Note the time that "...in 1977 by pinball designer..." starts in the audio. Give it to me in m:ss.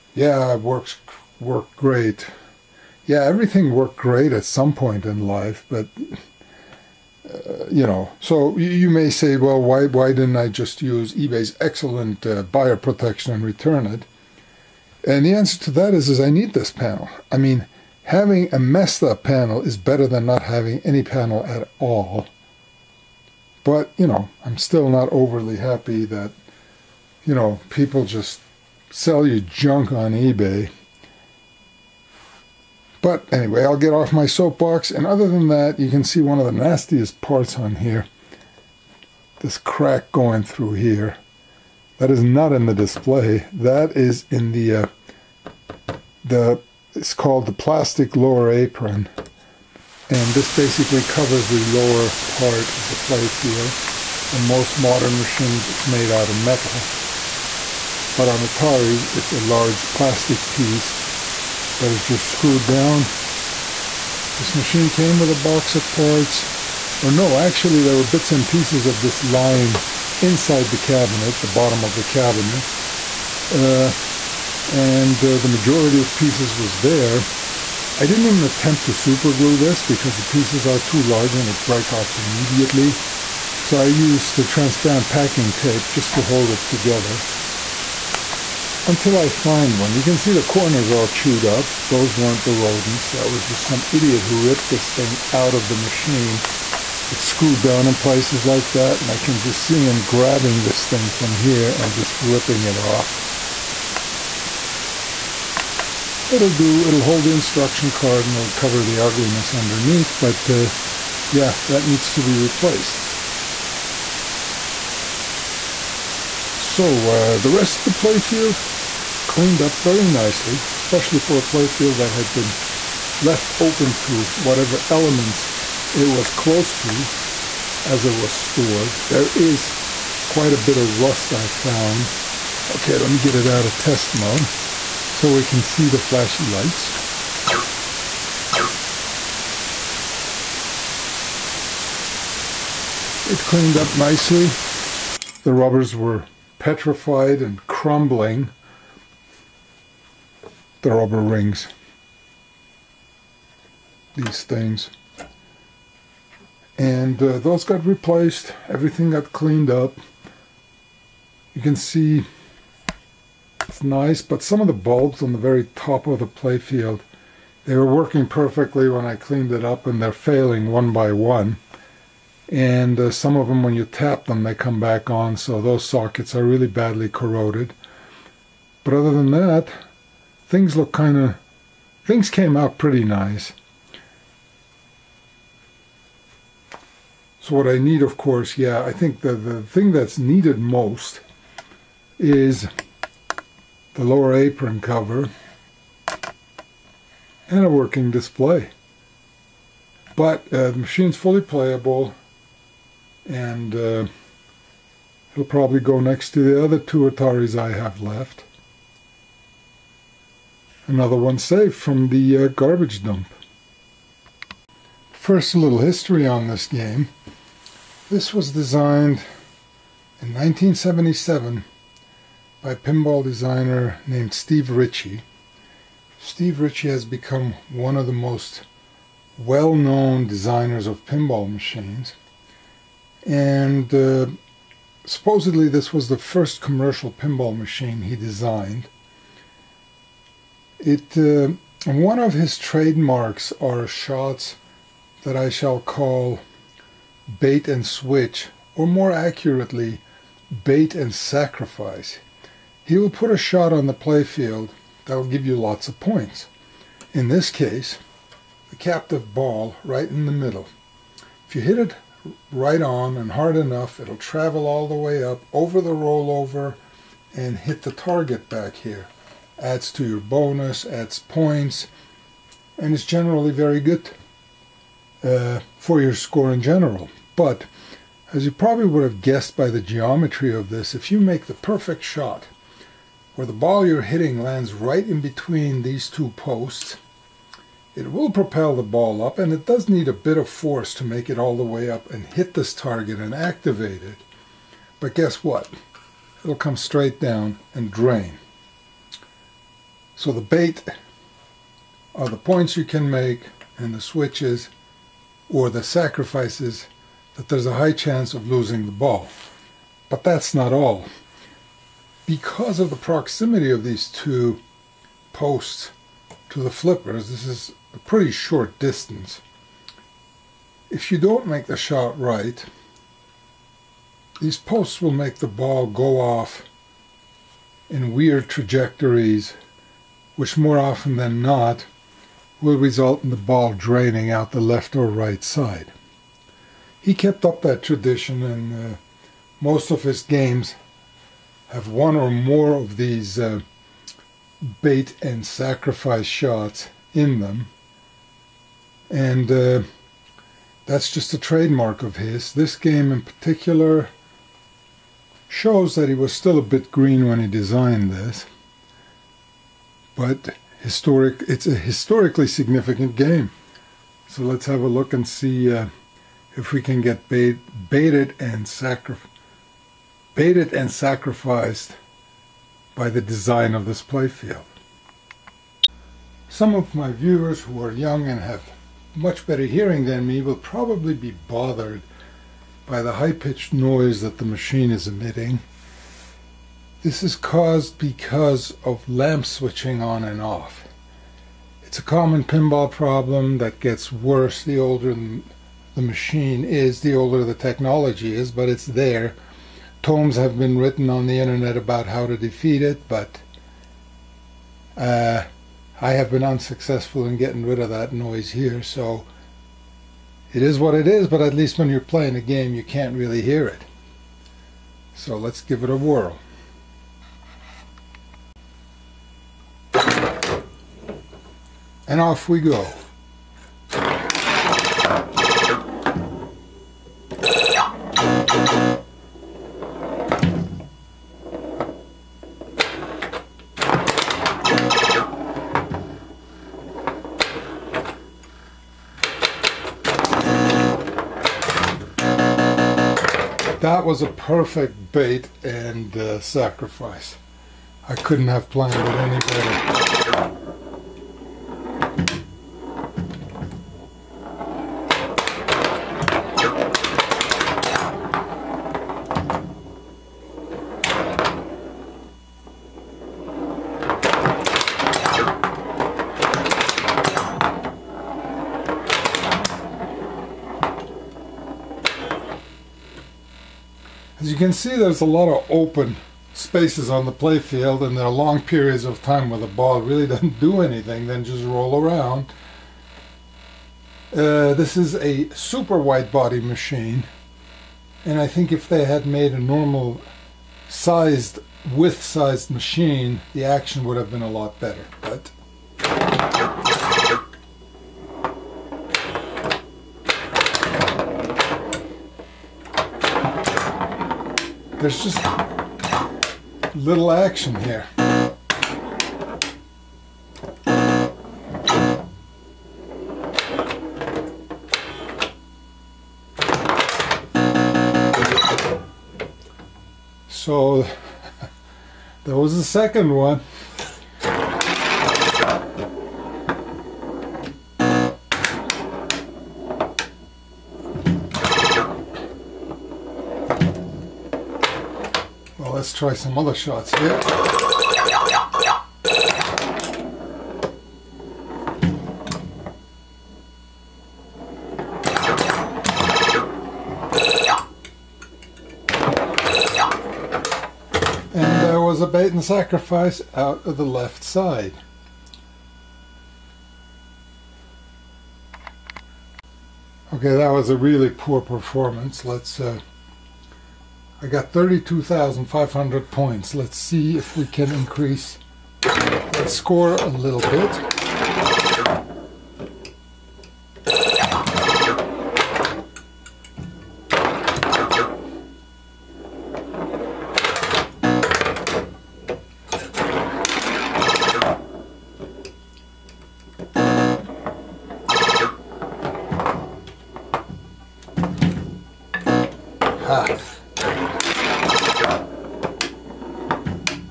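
3:40.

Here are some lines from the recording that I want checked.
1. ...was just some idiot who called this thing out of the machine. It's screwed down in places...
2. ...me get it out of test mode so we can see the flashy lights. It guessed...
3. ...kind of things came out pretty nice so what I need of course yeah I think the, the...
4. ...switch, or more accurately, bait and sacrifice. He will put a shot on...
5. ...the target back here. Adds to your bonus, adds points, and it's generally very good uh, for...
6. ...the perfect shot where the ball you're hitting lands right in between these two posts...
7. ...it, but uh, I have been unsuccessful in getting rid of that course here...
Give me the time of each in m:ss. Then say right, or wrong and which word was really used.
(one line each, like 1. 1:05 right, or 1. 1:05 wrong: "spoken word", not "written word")
1. 1:33 wrong: "ripped", not "called"
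2. 2:13 wrong: "cleaned", not "guessed"
3. 3:00 right
4. 4:07 right
5. 4:27 right
6. 4:41 right
7. 6:42 wrong: "noise", not "course".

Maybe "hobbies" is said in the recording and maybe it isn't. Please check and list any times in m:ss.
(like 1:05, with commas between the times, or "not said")
not said.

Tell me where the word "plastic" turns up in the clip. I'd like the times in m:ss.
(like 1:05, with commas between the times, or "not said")
0:47, 0:59.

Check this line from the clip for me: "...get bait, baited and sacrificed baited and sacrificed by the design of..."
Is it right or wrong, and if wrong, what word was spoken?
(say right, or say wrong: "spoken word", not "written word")
right.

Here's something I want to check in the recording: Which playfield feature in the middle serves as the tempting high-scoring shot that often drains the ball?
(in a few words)
captive ball.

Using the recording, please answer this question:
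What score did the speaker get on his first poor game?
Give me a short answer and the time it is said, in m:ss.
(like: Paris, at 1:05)
32,500, at 9:24.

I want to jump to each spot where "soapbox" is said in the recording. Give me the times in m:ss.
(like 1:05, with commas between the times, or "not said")
0:34.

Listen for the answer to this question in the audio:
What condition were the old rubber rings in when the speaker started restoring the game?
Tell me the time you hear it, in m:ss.
2:26.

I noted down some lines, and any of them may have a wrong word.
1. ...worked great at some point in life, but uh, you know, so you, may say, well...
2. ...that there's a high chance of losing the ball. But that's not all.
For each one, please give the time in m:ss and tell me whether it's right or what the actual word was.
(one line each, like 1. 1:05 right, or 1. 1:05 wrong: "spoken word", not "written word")
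1. 0:03 right
2. 5:07 right.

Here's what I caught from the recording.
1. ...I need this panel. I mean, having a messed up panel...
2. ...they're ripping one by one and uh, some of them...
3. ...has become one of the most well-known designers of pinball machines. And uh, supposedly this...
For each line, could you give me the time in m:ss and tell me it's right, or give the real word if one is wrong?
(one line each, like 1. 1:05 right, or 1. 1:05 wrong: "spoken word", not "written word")
1. 0:16 right
2. 2:50 wrong: "failing", not "ripping"
3. 3:46 right.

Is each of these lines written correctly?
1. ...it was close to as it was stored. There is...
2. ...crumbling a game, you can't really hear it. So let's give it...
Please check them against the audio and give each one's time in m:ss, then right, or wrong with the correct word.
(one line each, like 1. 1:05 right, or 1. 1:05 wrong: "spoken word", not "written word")
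1. 2:05 right
2. 6:52 wrong: "playing", not "crumbling".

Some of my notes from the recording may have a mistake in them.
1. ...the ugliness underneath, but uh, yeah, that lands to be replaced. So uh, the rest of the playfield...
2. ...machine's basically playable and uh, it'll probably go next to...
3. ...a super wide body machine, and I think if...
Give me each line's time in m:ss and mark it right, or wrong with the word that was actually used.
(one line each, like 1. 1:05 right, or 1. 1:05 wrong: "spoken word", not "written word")
1. 1:48 wrong: "needs", not "lands"
2. 3:20 wrong: "fully", not "basically"
3. 8:05 right.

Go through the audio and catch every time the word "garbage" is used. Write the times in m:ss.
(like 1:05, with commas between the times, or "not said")
3:32.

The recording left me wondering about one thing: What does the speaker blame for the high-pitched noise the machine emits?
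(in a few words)
lamp switching.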